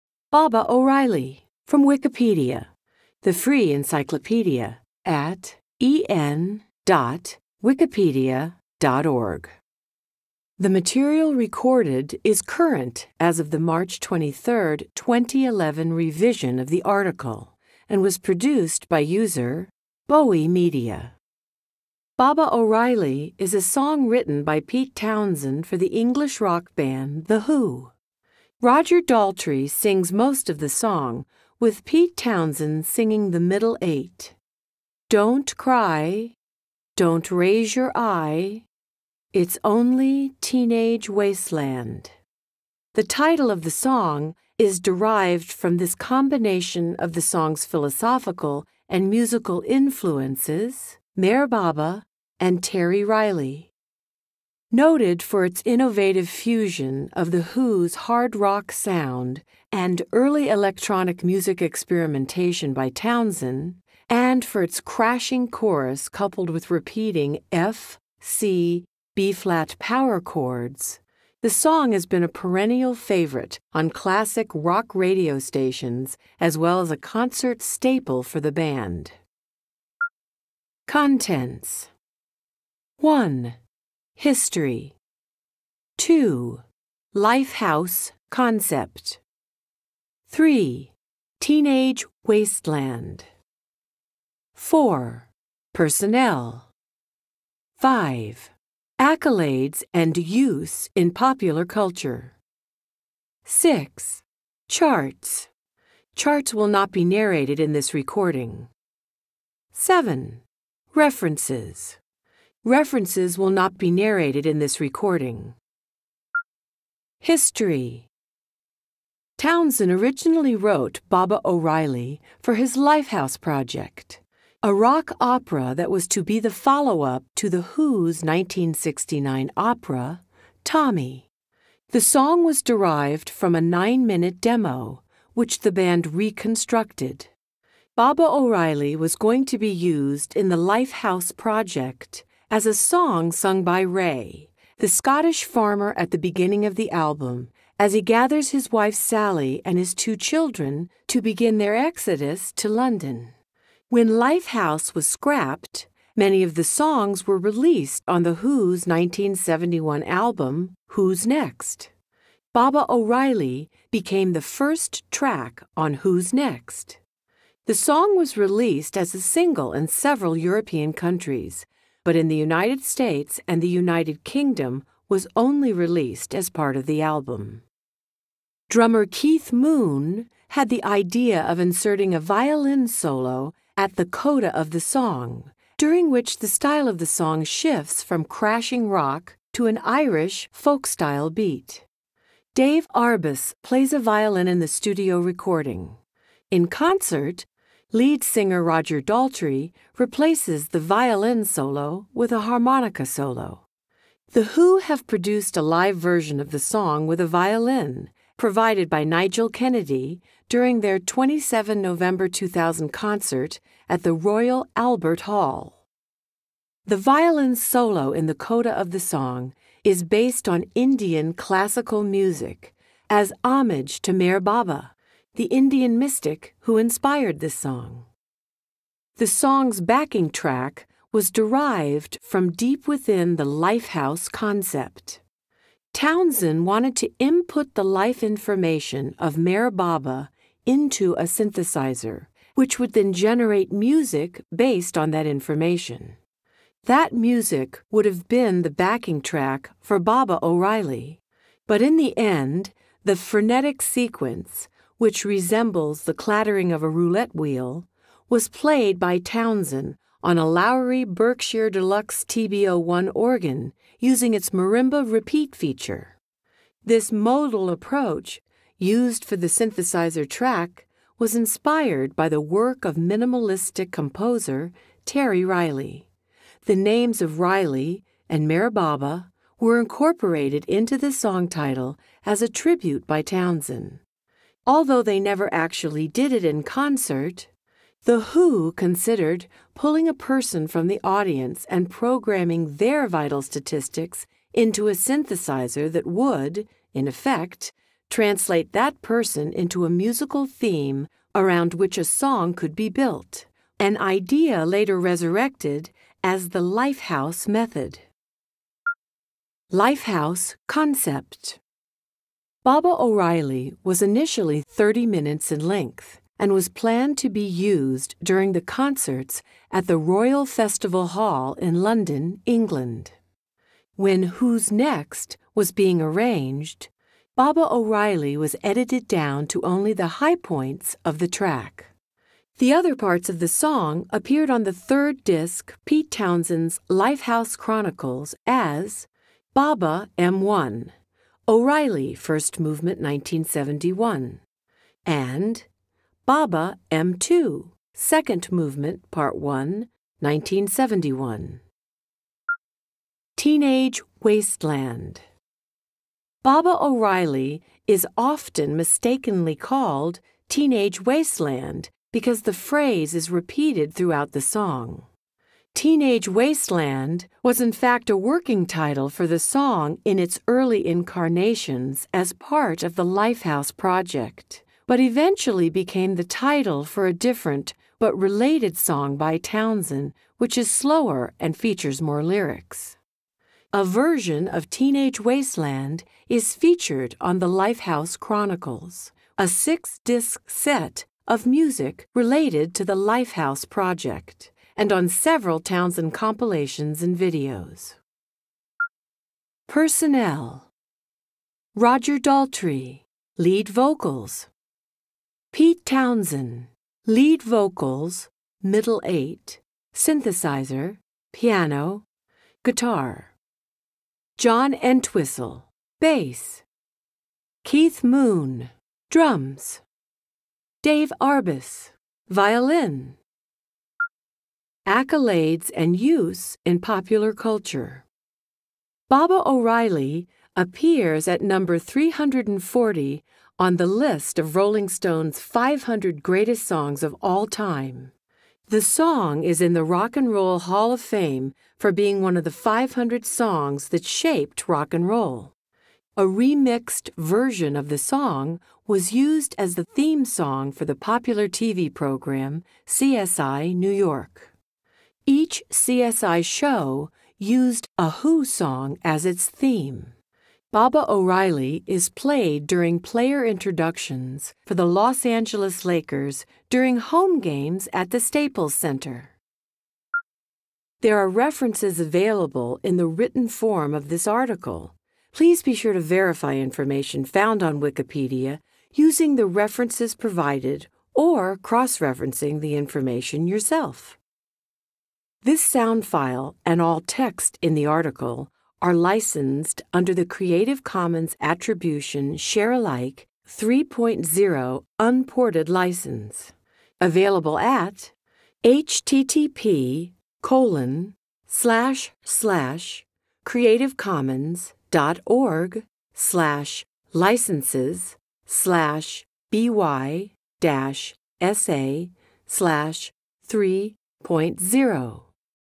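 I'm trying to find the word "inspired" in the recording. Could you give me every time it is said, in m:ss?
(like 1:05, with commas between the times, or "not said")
3:46, 4:31.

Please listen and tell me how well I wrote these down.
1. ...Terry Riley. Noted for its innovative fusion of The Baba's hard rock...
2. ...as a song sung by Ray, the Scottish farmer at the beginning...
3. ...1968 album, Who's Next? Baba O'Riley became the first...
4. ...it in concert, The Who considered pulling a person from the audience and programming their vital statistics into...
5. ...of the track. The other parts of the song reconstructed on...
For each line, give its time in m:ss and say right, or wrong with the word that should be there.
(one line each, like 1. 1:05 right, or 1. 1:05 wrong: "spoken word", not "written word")
1. 0:52 wrong: "Who", not "Baba"
2. 2:22 right
3. 2:38 wrong: "1971", not "1968"
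4. 4:46 right
5. 5:31 wrong: "appeared", not "reconstructed".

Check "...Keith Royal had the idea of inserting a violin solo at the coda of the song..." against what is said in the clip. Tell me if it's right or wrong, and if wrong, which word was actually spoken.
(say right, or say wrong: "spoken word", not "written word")
wrong: "Moon", not "Royal".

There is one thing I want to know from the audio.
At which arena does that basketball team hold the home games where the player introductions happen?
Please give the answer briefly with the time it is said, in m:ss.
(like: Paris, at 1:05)
Staples Center, at 7:48.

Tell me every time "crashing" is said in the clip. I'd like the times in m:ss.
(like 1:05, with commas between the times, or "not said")
1:04, 3:08.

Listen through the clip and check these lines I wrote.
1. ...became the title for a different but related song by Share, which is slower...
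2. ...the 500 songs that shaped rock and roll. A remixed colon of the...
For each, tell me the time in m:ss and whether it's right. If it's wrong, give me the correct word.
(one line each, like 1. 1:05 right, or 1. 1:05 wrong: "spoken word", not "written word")
1. 6:15 wrong: "Townshend", not "Share"
2. 7:22 wrong: "version", not "colon".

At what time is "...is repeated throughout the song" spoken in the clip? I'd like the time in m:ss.
6:03.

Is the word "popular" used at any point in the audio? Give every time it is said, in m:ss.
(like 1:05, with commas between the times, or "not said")
1:41, 7:06, 7:30.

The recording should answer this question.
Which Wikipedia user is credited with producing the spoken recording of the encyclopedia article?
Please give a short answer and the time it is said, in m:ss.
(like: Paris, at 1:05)
Bowie Media, at 0:20.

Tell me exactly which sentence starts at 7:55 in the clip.
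Please be sure to verify information found on Wikipedia using the references provided or cross referencing the information yourself.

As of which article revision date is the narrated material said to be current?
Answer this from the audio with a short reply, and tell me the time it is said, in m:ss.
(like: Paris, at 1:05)
March 23, 2011, at 0:13.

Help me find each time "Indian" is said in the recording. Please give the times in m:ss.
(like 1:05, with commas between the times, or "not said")
3:40, 3:45.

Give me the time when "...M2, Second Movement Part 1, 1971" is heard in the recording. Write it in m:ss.
5:46.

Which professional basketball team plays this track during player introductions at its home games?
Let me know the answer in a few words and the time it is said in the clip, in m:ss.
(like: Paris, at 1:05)
Los Angeles Lakers, at 7:44.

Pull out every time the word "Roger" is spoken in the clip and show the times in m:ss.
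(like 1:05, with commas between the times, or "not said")
0:28, 3:18, 6:41.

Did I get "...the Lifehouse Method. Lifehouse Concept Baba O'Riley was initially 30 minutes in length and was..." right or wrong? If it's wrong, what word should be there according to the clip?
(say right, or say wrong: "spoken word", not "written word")
right.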